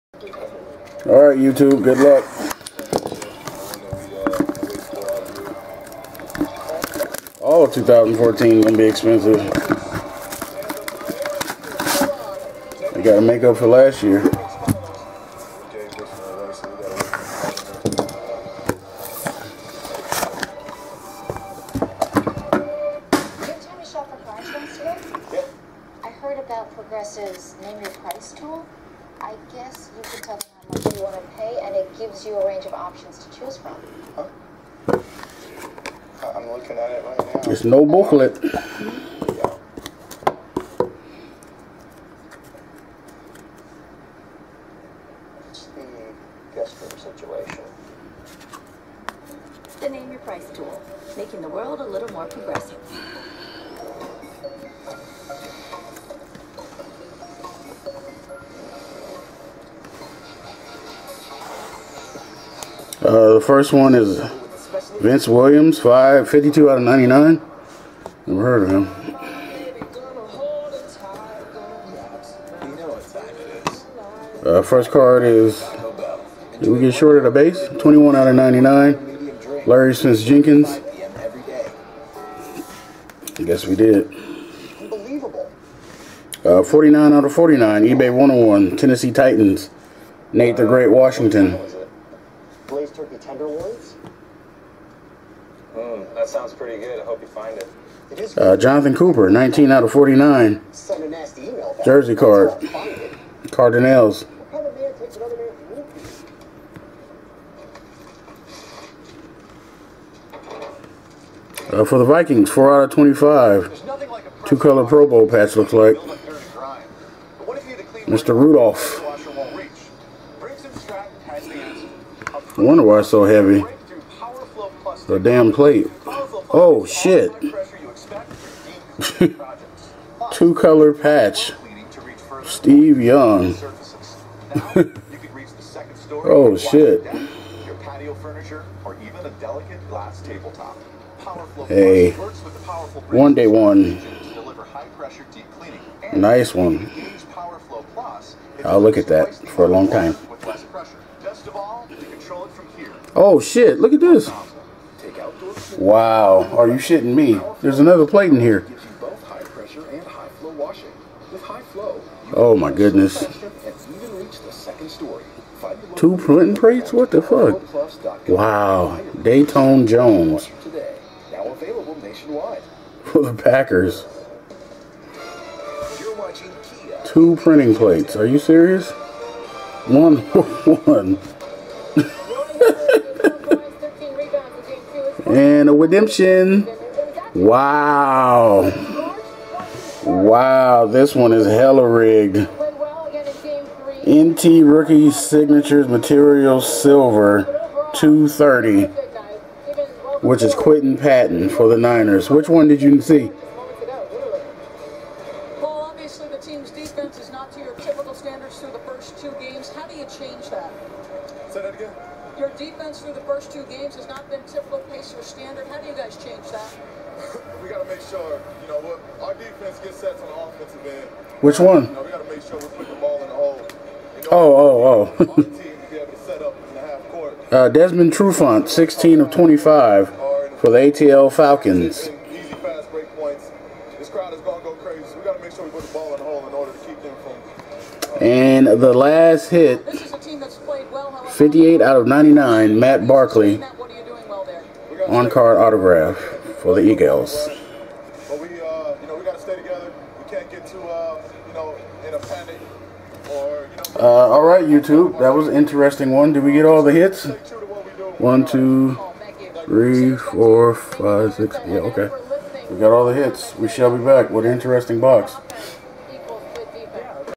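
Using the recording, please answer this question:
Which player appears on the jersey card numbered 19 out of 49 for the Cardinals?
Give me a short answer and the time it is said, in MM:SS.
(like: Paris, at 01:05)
Jonathan Cooper, at 01:38.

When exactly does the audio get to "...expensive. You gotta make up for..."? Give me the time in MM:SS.
00:08.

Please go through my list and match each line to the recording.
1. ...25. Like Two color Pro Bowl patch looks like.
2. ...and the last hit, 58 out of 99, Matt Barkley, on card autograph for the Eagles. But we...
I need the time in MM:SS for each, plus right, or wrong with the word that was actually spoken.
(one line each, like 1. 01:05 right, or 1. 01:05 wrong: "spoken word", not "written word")
1. 01:52 right
2. 03:58 right.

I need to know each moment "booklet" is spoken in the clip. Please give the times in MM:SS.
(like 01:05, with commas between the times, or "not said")
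00:37.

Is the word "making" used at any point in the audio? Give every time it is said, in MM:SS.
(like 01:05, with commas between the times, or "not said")
00:51.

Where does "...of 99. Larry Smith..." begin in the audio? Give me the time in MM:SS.
01:18.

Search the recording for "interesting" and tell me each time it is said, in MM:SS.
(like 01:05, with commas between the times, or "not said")
04:15, 04:24.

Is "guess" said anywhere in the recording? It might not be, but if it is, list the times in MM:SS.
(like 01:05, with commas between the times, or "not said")
00:29, 01:23.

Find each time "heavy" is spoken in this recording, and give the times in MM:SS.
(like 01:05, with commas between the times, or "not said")
02:03.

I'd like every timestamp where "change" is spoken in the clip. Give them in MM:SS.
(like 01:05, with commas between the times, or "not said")
03:30, 03:36.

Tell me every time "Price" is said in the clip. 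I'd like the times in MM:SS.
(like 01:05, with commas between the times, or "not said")
00:27, 00:50.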